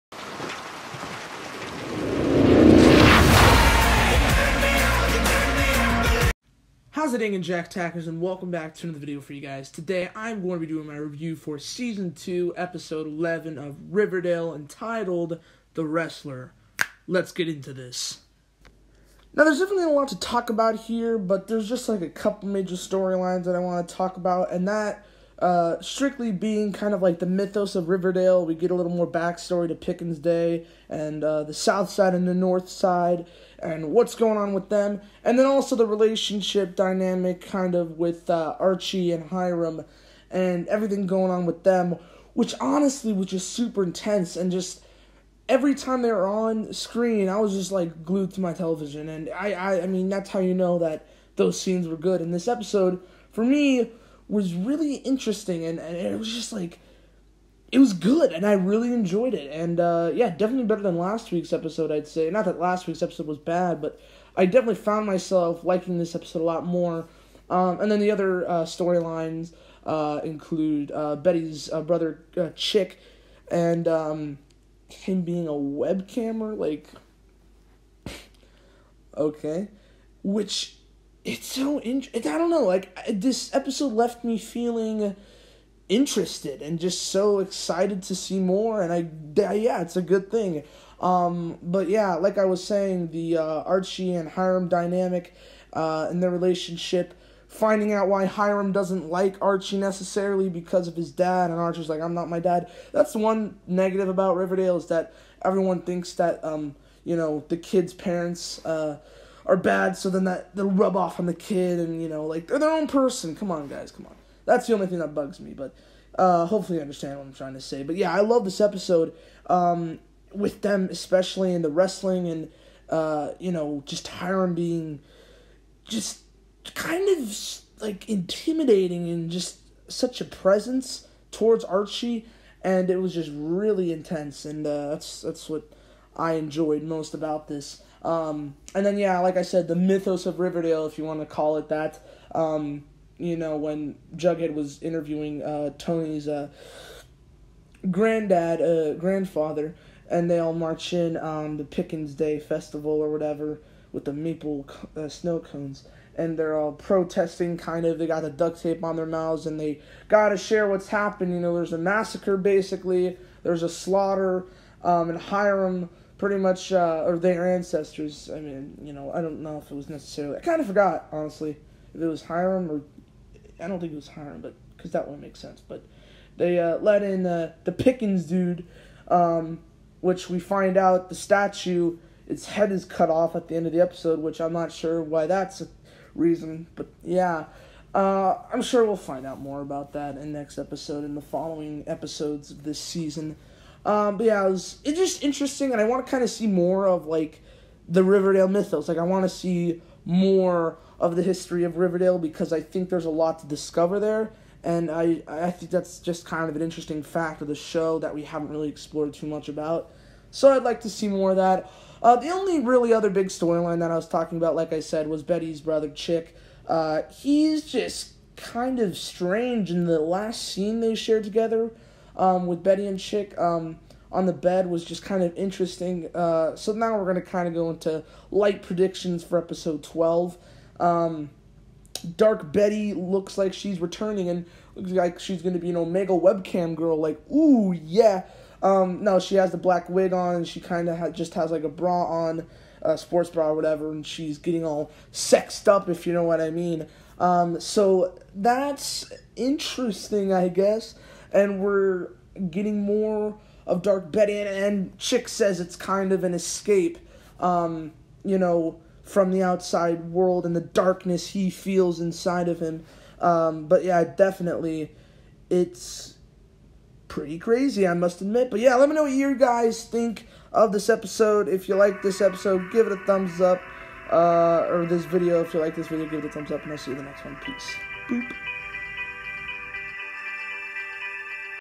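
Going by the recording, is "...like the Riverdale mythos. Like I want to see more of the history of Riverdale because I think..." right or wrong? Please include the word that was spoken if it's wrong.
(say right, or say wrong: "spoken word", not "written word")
right.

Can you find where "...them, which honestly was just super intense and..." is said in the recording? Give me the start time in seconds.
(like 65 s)
41 s.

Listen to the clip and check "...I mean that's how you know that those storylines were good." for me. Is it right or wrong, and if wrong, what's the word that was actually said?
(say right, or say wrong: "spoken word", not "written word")
wrong: "scenes", not "storylines".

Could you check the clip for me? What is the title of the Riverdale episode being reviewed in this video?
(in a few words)
The Wrestler.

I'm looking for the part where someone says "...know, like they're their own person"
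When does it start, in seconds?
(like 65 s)
112 s.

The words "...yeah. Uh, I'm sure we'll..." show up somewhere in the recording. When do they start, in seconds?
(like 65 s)
187 s.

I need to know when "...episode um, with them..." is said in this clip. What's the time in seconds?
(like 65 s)
118 s.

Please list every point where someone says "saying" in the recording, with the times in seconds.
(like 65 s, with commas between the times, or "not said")
92 s.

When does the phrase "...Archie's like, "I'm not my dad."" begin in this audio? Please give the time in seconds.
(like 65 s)
101 s.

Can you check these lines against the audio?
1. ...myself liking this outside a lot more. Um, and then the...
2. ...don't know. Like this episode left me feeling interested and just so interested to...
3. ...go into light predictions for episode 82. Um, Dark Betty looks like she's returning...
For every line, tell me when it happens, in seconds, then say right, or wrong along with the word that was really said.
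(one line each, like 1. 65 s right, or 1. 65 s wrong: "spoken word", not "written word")
1. 65 s wrong: "episode", not "outside"
2. 82 s wrong: "excited", not "interested"
3. 227 s wrong: "12", not "82".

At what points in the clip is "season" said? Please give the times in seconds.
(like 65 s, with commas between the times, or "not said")
11 s, 192 s.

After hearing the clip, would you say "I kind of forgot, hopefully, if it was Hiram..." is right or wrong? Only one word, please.
wrong.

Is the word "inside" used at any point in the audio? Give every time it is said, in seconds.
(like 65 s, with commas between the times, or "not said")
261 s.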